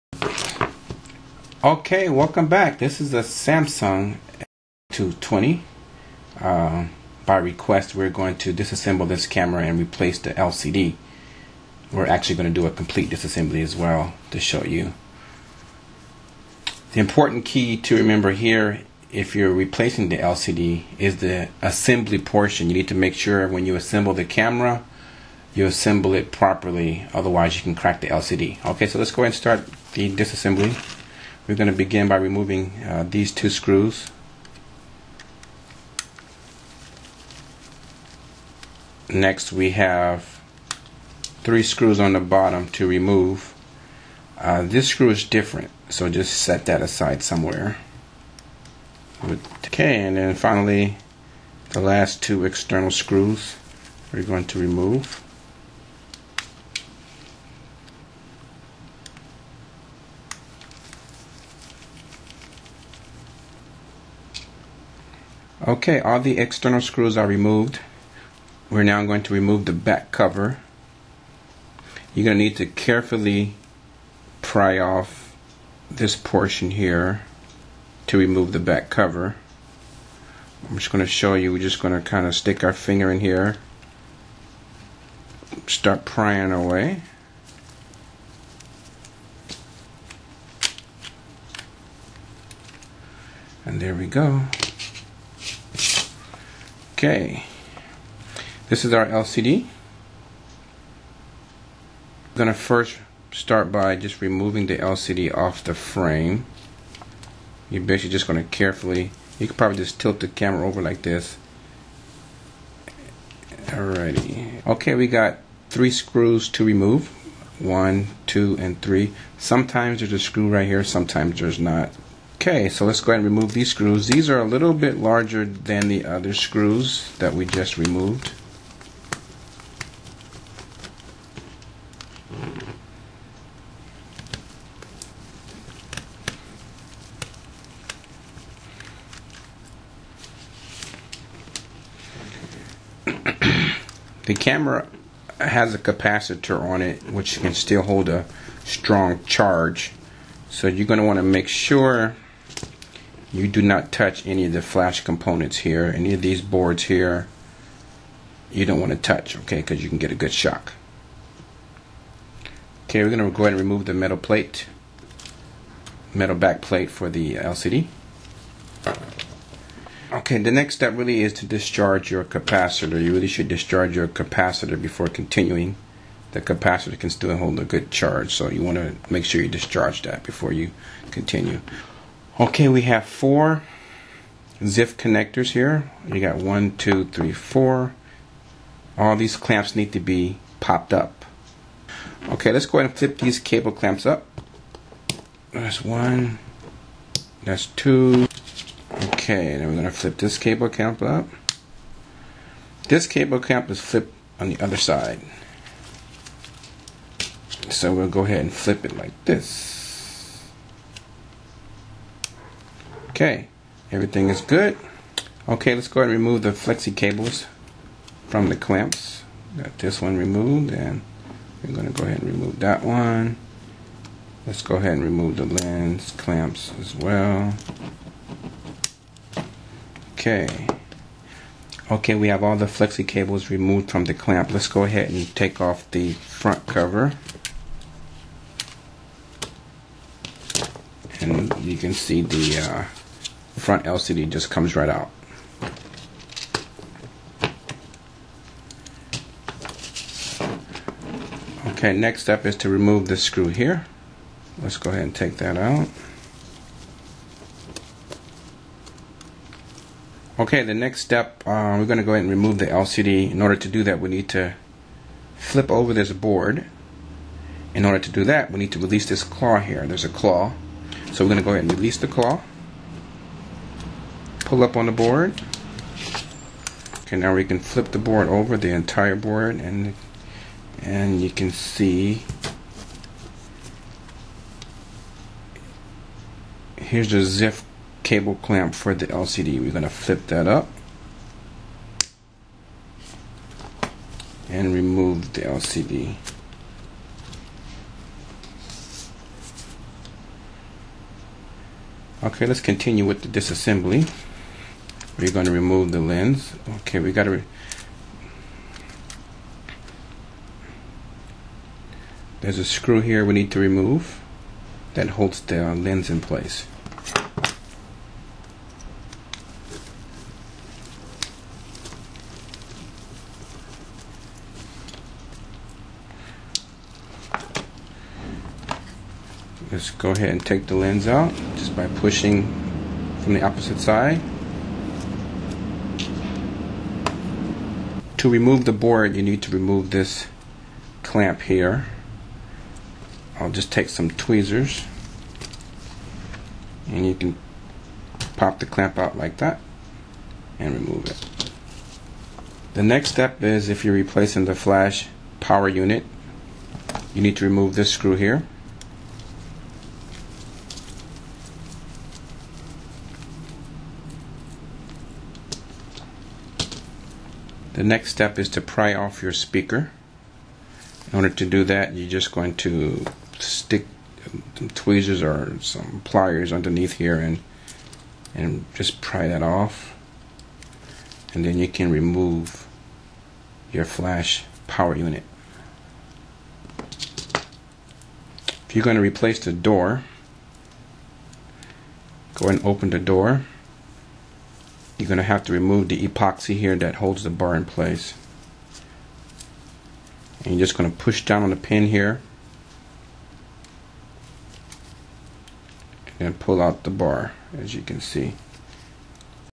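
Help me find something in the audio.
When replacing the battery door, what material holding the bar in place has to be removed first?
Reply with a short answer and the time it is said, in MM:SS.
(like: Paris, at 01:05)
epoxy, at 06:36.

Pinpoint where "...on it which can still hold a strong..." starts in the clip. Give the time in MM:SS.
02:26.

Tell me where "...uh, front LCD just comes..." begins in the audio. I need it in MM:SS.
04:02.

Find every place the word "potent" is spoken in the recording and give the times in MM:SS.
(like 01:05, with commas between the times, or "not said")
not said.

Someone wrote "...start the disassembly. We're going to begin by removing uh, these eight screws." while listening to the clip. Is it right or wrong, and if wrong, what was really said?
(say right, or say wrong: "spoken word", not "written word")
wrong: "two", not "eight".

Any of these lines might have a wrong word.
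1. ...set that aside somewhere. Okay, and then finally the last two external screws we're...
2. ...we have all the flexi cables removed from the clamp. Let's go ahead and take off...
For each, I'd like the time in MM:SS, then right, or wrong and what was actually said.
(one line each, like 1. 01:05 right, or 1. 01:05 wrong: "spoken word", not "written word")
1. 00:46 right
2. 03:52 right.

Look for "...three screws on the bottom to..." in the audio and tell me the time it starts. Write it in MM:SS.
00:41.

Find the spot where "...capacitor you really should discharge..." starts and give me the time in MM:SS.
02:52.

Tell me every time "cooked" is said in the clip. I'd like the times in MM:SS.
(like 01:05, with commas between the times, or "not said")
not said.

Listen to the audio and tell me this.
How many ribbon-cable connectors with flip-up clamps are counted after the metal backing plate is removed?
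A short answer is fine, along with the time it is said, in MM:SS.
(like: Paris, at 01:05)
4, at 03:03.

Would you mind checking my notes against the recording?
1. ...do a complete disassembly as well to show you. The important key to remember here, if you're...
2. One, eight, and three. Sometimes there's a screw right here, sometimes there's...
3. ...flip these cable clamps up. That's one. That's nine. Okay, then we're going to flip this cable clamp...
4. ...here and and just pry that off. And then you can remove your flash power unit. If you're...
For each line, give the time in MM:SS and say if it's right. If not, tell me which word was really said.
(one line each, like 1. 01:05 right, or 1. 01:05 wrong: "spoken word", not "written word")
1. 00:12 right
2. 01:57 wrong: "two", not "eight"
3. 03:12 wrong: "two", not "nine"
4. 06:16 right.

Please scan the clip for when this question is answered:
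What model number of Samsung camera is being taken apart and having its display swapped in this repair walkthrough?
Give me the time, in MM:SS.
00:03.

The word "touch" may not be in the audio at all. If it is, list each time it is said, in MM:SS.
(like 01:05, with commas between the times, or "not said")
02:33, 02:38.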